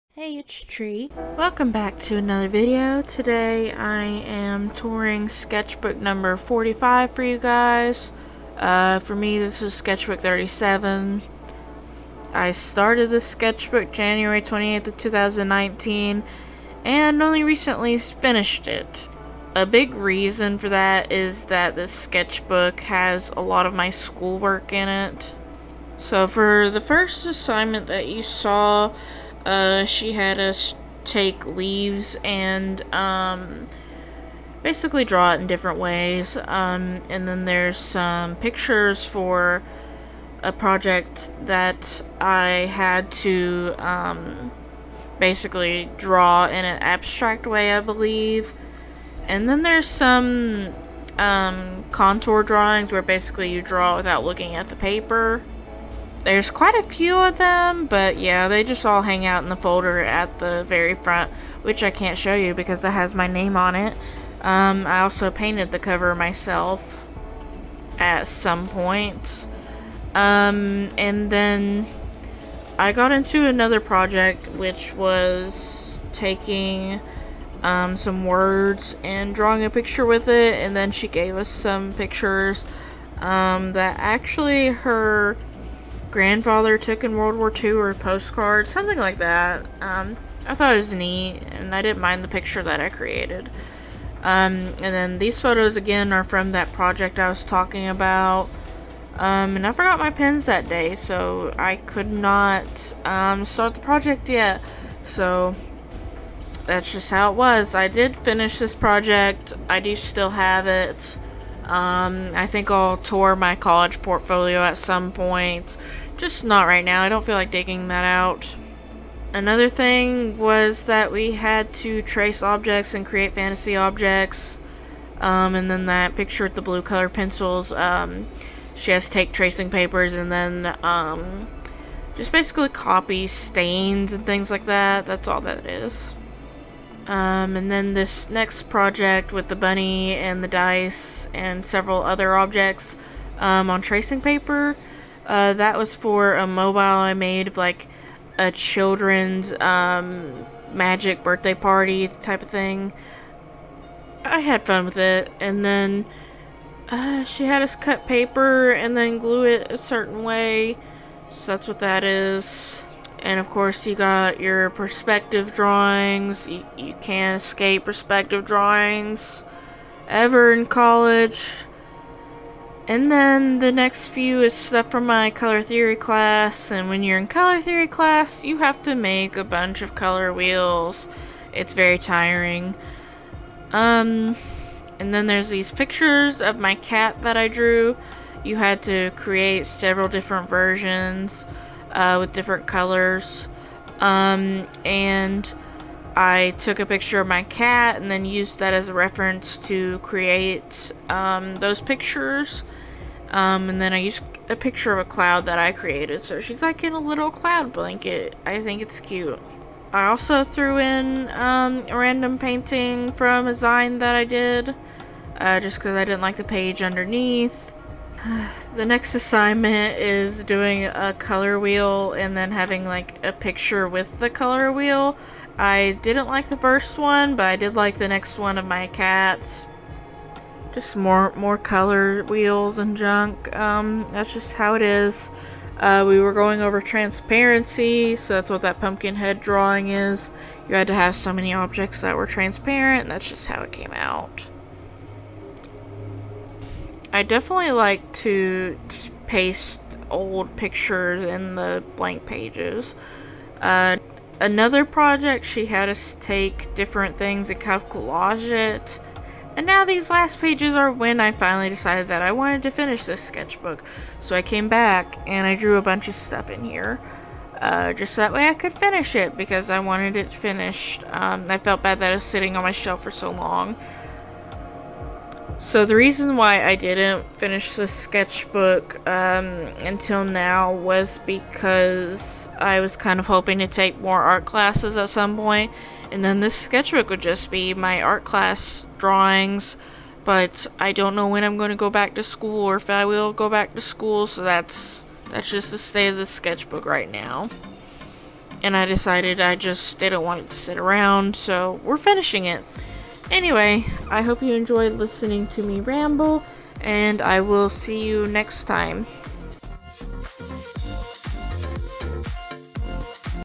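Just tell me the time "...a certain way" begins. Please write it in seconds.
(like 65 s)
159 s.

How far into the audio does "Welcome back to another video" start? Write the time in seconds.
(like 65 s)
1 s.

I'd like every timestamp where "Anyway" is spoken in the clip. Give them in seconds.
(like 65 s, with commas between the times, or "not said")
303 s.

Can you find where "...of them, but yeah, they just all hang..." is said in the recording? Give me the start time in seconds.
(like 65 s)
57 s.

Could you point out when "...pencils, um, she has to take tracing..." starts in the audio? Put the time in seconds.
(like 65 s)
127 s.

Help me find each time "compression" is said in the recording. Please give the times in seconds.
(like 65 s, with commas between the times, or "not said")
not said.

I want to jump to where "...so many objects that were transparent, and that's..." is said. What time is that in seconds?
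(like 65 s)
241 s.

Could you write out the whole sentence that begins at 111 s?
Um, I think I'll tour my college portfolio at some point.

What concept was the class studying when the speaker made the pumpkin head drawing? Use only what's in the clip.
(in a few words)
Transparency.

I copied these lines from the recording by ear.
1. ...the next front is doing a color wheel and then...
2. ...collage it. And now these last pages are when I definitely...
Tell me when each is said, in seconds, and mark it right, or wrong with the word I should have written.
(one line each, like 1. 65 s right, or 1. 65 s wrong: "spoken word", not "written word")
1. 218 s wrong: "assignment", not "front"
2. 257 s wrong: "finally", not "definitely".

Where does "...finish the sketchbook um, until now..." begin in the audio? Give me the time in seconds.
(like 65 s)
277 s.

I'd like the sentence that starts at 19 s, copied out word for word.
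A big reason for that is that this sketchbook has a lot of my schoolwork in it.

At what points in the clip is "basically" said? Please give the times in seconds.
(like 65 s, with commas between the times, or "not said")
34 s, 45 s, 53 s, 132 s.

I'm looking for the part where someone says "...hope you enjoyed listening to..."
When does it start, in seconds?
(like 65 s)
304 s.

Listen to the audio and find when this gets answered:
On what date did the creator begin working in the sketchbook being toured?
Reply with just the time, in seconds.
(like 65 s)
13 s.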